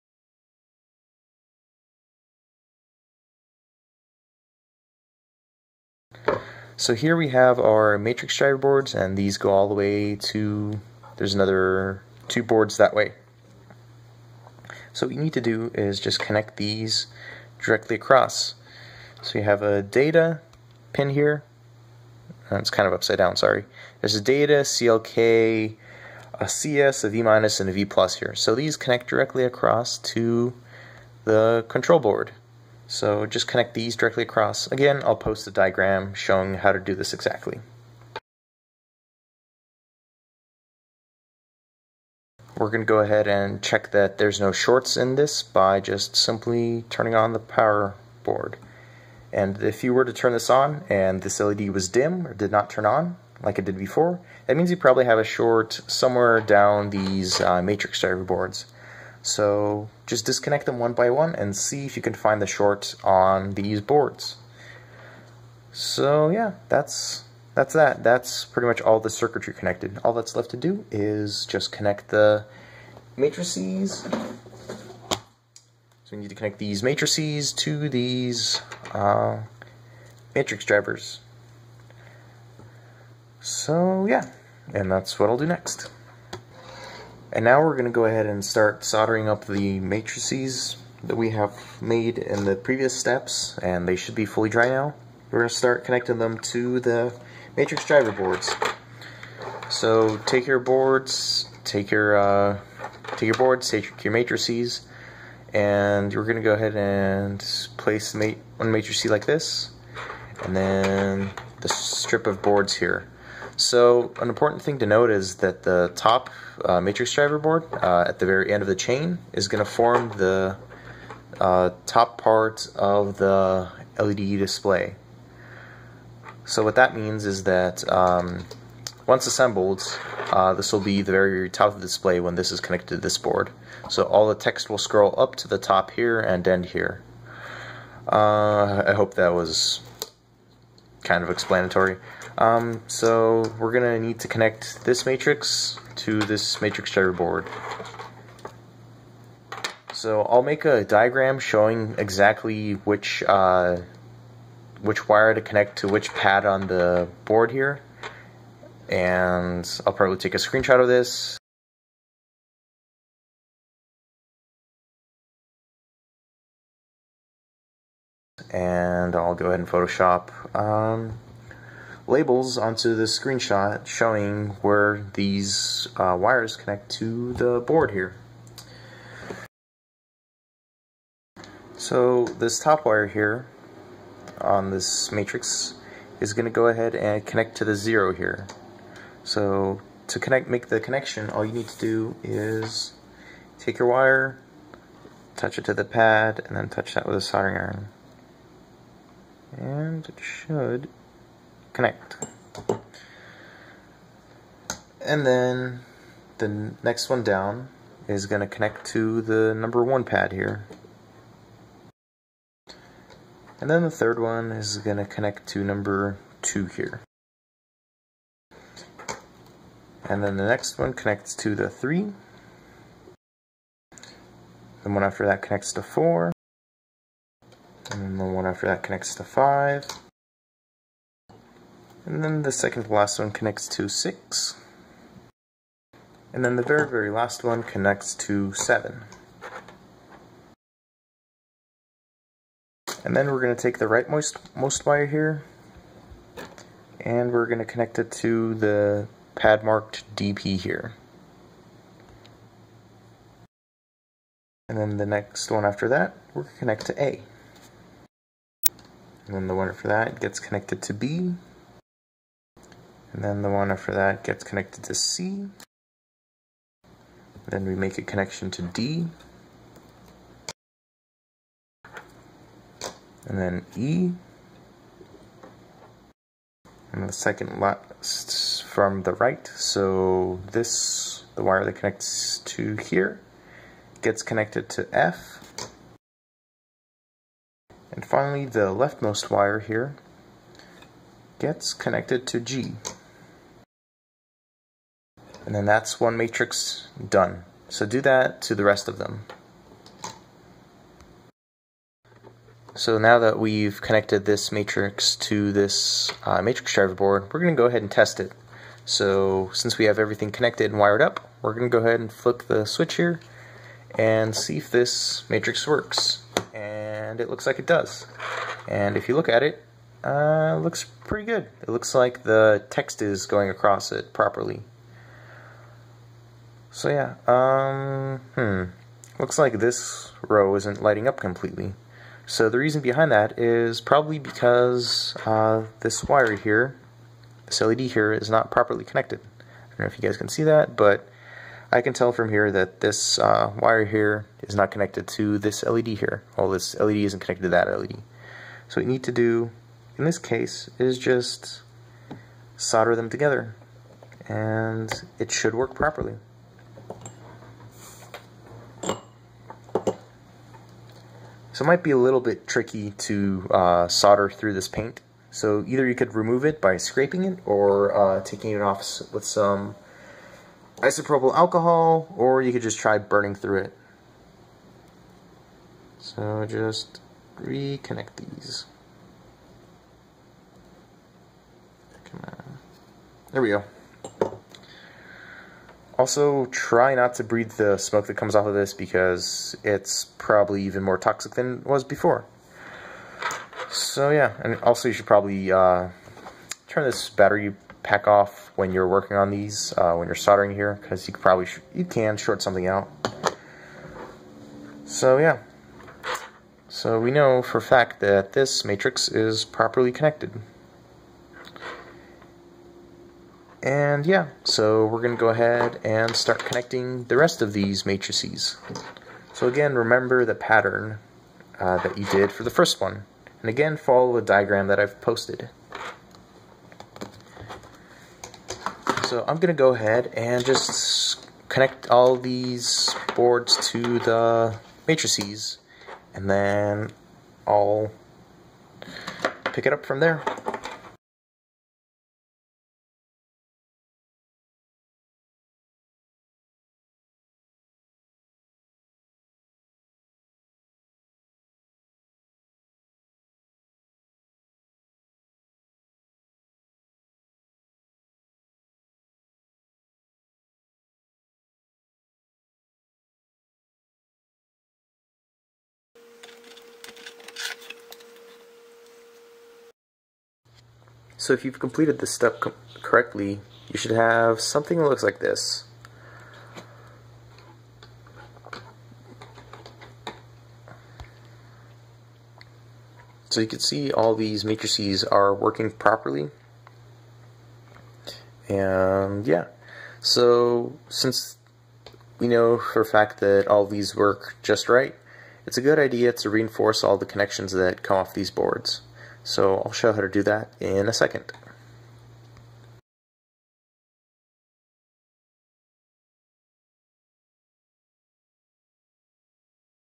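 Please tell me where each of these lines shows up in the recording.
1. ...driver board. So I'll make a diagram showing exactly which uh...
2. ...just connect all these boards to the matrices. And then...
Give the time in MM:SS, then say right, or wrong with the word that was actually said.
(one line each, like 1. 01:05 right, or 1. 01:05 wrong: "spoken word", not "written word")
1. 02:26 right
2. 07:10 right.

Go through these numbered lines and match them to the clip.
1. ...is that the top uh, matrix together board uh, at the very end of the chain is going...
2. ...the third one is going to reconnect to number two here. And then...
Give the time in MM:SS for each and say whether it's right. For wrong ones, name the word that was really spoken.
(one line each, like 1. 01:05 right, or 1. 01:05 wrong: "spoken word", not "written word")
1. 01:55 wrong: "driver", not "together"
2. 03:33 wrong: "connect", not "reconnect".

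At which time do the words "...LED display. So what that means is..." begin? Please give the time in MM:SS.
02:03.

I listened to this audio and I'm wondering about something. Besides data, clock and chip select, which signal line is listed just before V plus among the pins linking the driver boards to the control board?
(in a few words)
V minus.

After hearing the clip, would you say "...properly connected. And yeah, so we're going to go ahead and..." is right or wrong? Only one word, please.
right.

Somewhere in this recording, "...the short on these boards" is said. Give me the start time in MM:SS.
01:02.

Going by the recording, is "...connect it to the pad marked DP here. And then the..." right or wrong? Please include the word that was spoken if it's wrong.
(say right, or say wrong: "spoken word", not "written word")
right.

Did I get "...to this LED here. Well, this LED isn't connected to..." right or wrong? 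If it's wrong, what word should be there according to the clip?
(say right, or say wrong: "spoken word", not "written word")
right.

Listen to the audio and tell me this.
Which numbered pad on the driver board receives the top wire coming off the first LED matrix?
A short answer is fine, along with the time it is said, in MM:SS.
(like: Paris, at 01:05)
0, at 03:07.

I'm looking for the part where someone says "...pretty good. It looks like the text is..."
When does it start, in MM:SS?
05:21.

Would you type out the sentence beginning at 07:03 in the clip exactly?
And again, follow the diagram that I've posted.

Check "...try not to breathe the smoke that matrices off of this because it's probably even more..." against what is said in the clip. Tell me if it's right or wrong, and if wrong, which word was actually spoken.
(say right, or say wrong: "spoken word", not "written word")
wrong: "comes", not "matrices".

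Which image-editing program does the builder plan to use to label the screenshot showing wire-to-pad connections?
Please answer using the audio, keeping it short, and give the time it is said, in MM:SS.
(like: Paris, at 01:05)
Photoshop, at 02:49.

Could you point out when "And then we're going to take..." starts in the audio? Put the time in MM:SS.
04:03.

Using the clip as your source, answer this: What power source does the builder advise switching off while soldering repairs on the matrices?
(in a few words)
battery pack.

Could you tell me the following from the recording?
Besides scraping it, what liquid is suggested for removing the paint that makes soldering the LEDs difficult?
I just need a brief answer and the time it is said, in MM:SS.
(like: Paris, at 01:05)
isopropyl alcohol, at 06:10.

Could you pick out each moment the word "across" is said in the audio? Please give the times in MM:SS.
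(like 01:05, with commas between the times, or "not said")
00:17, 00:29, 00:34, 05:23.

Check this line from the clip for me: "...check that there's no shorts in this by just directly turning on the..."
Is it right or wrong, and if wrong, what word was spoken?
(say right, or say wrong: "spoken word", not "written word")
wrong: "simply", not "directly".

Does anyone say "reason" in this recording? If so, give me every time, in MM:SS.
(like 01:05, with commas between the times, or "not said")
05:32.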